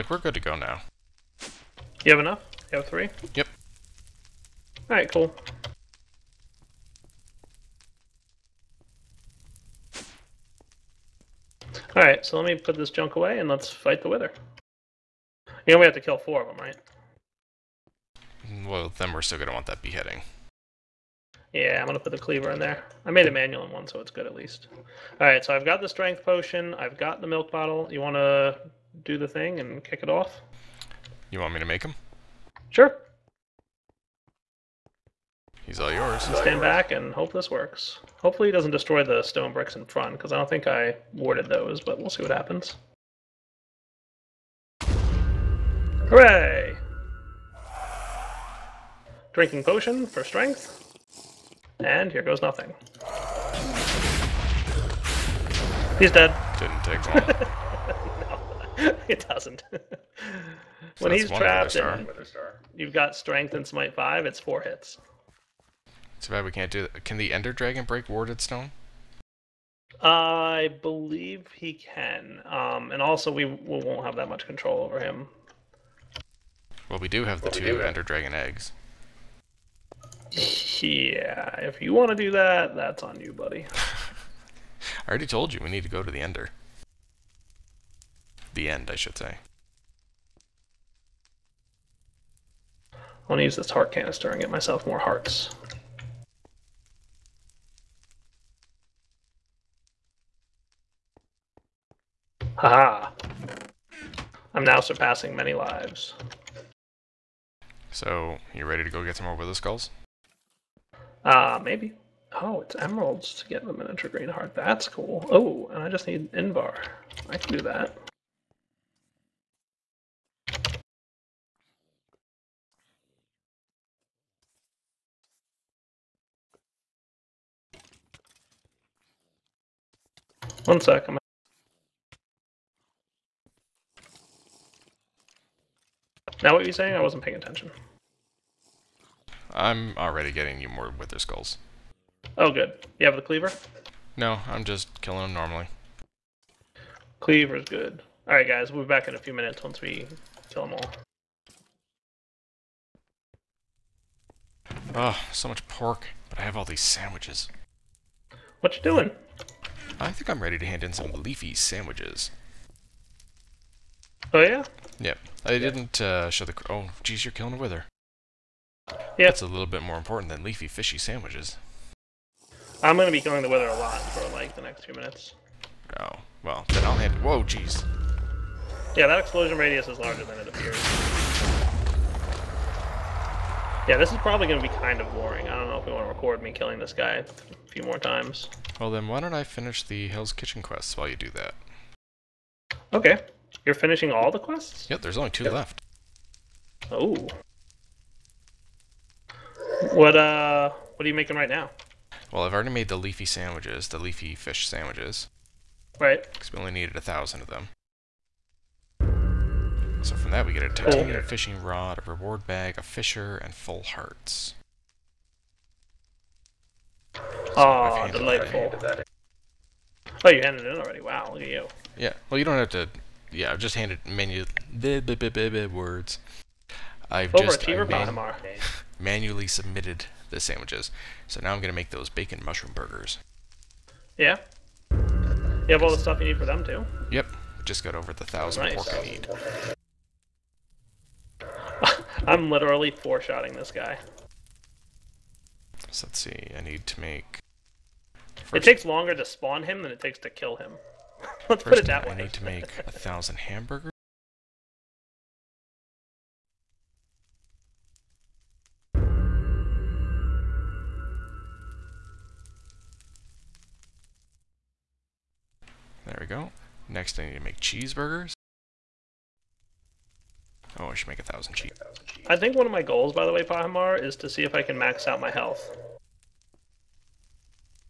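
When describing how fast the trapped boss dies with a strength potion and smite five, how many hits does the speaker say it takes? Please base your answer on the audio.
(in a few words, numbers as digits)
4.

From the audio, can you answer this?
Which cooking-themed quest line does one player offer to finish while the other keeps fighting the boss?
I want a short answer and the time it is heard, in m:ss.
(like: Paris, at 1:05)
Hell's Kitchen, at 3:10.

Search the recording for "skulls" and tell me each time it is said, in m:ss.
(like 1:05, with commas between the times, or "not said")
1:49, 2:21.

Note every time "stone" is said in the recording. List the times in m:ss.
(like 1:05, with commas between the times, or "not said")
0:39, 1:08.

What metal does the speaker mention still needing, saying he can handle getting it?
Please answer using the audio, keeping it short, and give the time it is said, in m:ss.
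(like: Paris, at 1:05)
Invar, at 1:56.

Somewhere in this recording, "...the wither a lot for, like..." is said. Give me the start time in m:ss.
2:53.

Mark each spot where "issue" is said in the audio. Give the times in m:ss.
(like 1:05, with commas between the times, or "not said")
not said.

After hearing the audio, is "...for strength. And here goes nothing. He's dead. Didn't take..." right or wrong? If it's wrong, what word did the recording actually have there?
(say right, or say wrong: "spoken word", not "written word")
right.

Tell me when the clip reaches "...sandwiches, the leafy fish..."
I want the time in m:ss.
3:23.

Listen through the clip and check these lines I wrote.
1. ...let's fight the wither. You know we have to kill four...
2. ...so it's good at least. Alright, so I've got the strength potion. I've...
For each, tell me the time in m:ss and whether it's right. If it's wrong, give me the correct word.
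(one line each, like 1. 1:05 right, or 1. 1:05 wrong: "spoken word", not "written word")
1. 0:13 right
2. 0:23 right.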